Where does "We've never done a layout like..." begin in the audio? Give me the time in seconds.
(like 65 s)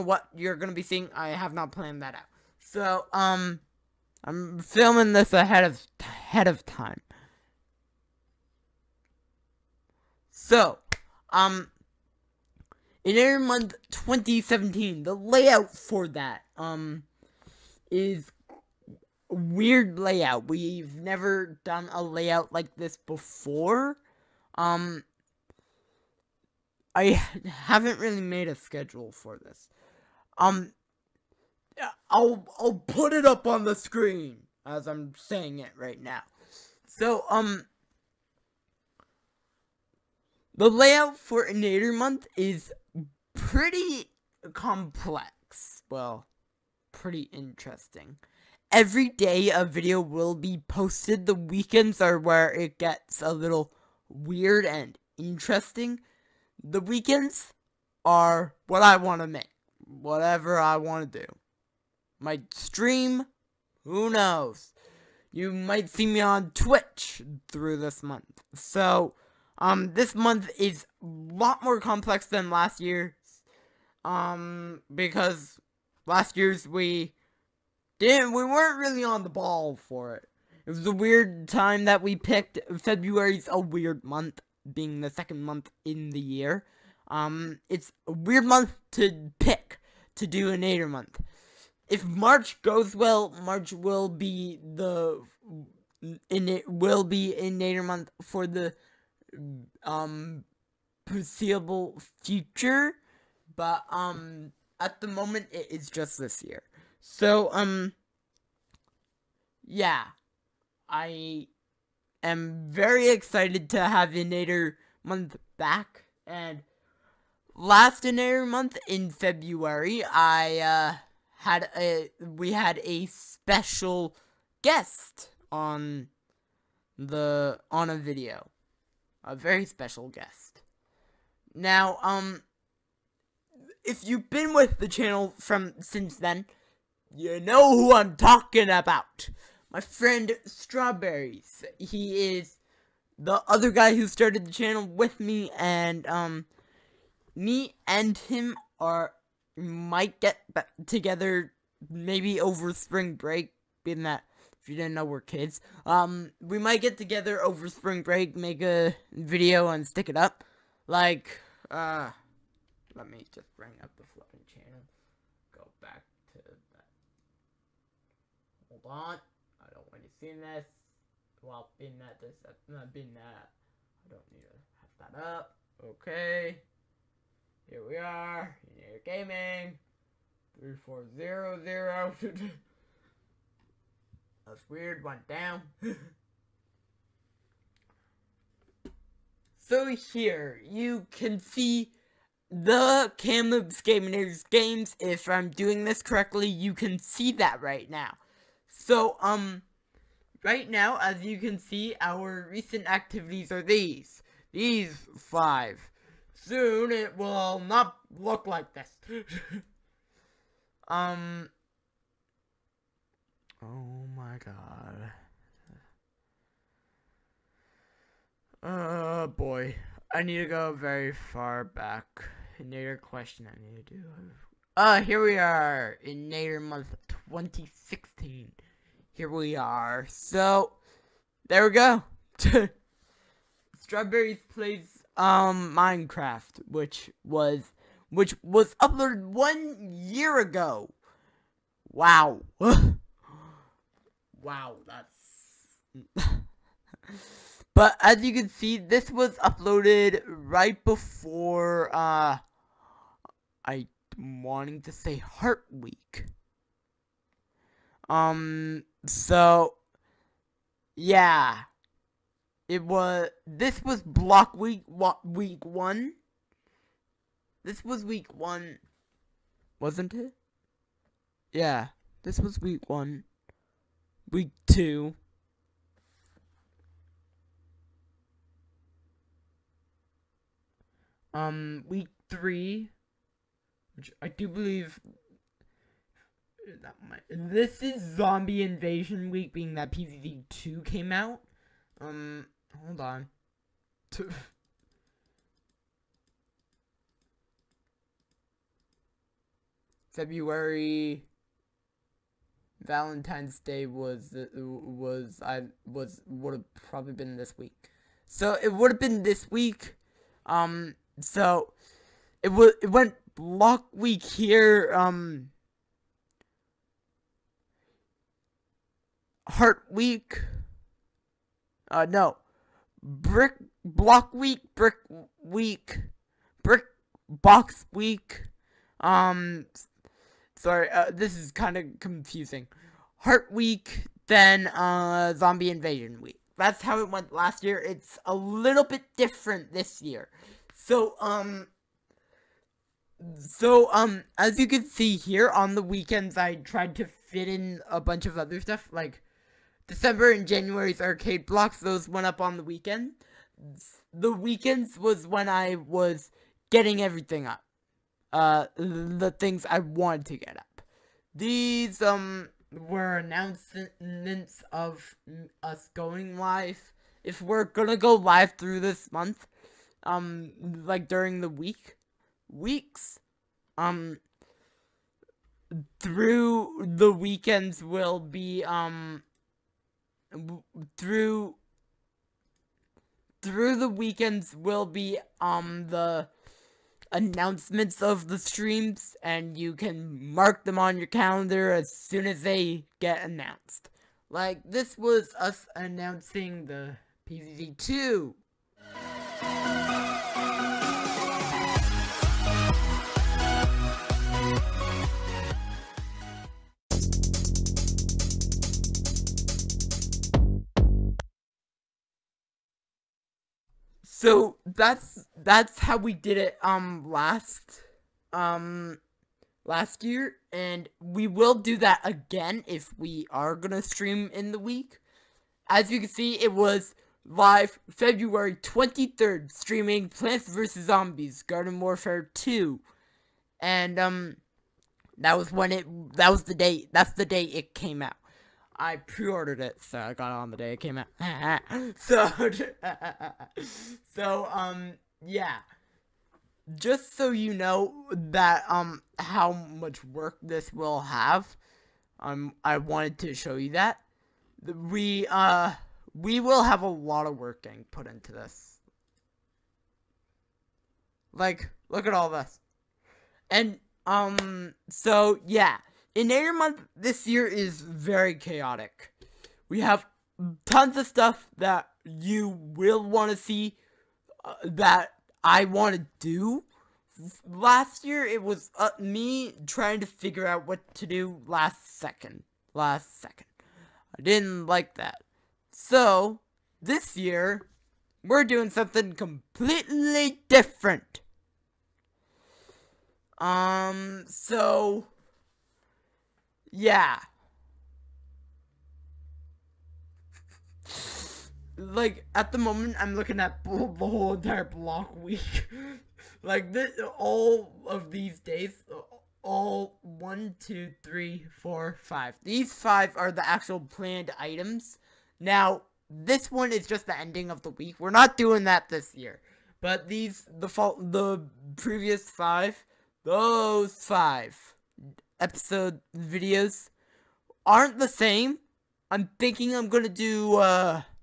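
20 s.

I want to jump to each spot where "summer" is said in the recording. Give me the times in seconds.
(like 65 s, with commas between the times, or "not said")
not said.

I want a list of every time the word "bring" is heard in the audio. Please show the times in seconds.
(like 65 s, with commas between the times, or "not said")
163 s.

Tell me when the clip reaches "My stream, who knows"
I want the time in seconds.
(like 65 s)
62 s.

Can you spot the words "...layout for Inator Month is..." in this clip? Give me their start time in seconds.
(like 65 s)
40 s.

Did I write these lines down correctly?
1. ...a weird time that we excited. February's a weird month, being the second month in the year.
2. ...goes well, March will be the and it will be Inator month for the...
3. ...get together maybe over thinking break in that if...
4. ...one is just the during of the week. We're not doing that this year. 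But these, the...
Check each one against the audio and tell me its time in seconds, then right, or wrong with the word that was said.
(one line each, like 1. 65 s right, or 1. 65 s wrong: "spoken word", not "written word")
1. 80 s wrong: "picked", not "excited"
2. 92 s right
3. 150 s wrong: "spring", not "thinking"
4. 516 s wrong: "ending", not "during".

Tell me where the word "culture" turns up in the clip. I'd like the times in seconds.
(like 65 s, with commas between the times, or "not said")
not said.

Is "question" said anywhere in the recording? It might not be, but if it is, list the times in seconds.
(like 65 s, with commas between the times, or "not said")
222 s.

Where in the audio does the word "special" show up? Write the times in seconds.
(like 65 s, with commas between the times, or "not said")
123 s, 129 s.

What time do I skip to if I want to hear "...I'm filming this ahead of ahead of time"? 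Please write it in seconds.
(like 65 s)
4 s.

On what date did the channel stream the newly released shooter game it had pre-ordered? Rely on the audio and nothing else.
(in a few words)
February 23rd.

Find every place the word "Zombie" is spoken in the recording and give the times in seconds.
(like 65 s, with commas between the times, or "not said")
288 s, 335 s, 430 s.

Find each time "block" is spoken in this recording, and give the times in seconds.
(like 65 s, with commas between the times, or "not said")
264 s, 313 s, 323 s, 351 s, 504 s.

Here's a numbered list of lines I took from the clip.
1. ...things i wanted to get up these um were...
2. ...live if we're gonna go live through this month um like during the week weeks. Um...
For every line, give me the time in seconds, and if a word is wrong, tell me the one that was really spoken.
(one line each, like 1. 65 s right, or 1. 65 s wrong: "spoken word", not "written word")
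1. 359 s right
2. 366 s right.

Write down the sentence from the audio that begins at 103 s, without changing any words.
But um, at the moment, it is just this year.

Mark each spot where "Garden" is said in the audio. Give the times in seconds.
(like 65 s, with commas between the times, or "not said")
431 s.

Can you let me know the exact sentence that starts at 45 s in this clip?
Well, pretty interesting every day a video will be posted.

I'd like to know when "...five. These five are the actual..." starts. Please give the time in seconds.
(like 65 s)
512 s.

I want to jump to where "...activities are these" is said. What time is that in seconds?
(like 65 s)
202 s.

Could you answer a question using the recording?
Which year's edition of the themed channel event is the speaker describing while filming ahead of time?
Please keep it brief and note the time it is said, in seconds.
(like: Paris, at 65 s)
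2017, at 13 s.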